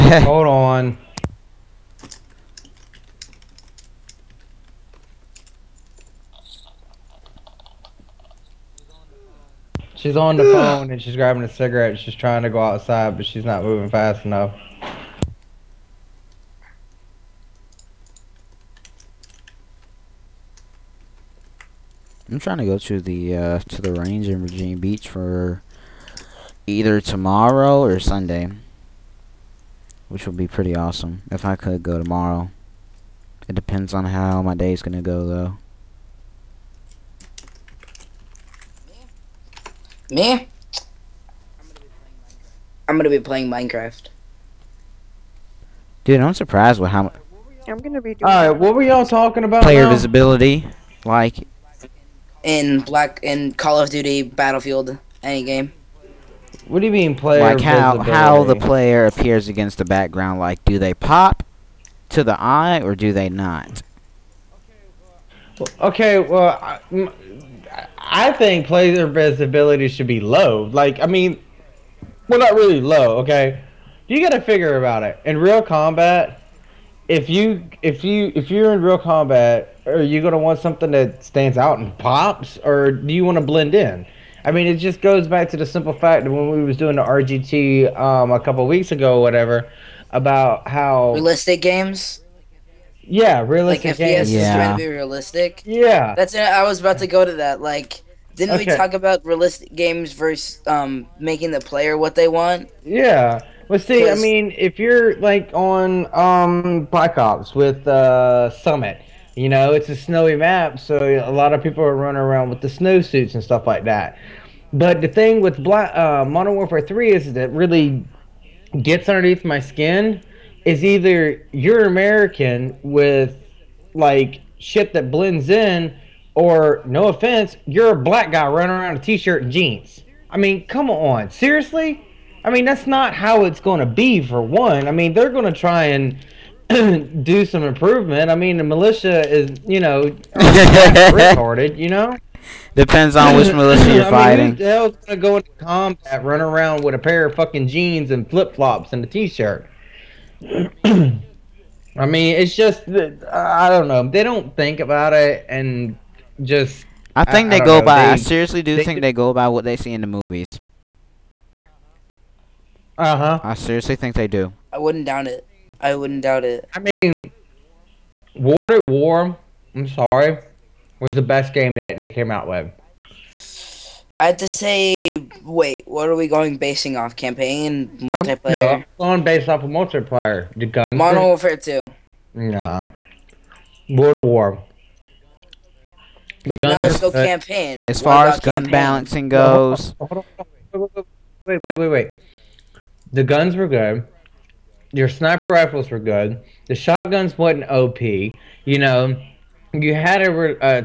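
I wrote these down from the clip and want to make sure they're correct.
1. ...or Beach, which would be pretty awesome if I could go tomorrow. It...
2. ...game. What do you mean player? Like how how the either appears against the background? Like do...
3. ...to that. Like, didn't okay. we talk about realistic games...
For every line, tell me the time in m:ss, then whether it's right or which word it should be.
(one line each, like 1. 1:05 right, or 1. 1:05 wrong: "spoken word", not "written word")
1. 0:27 wrong: "Sunday", not "Beach"
2. 0:55 wrong: "player", not "either"
3. 1:37 right.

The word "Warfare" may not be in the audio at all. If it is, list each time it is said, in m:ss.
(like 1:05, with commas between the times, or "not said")
1:56, 3:01.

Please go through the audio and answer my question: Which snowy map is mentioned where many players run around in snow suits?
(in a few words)
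Summit.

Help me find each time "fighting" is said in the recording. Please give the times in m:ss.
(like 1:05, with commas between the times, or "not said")
2:24.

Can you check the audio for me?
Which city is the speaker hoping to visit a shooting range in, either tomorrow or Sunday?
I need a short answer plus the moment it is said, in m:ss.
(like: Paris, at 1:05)
Virginia Beach, at 0:24.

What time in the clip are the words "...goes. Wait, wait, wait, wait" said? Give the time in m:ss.
3:09.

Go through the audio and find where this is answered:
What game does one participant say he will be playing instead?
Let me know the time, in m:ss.
0:43.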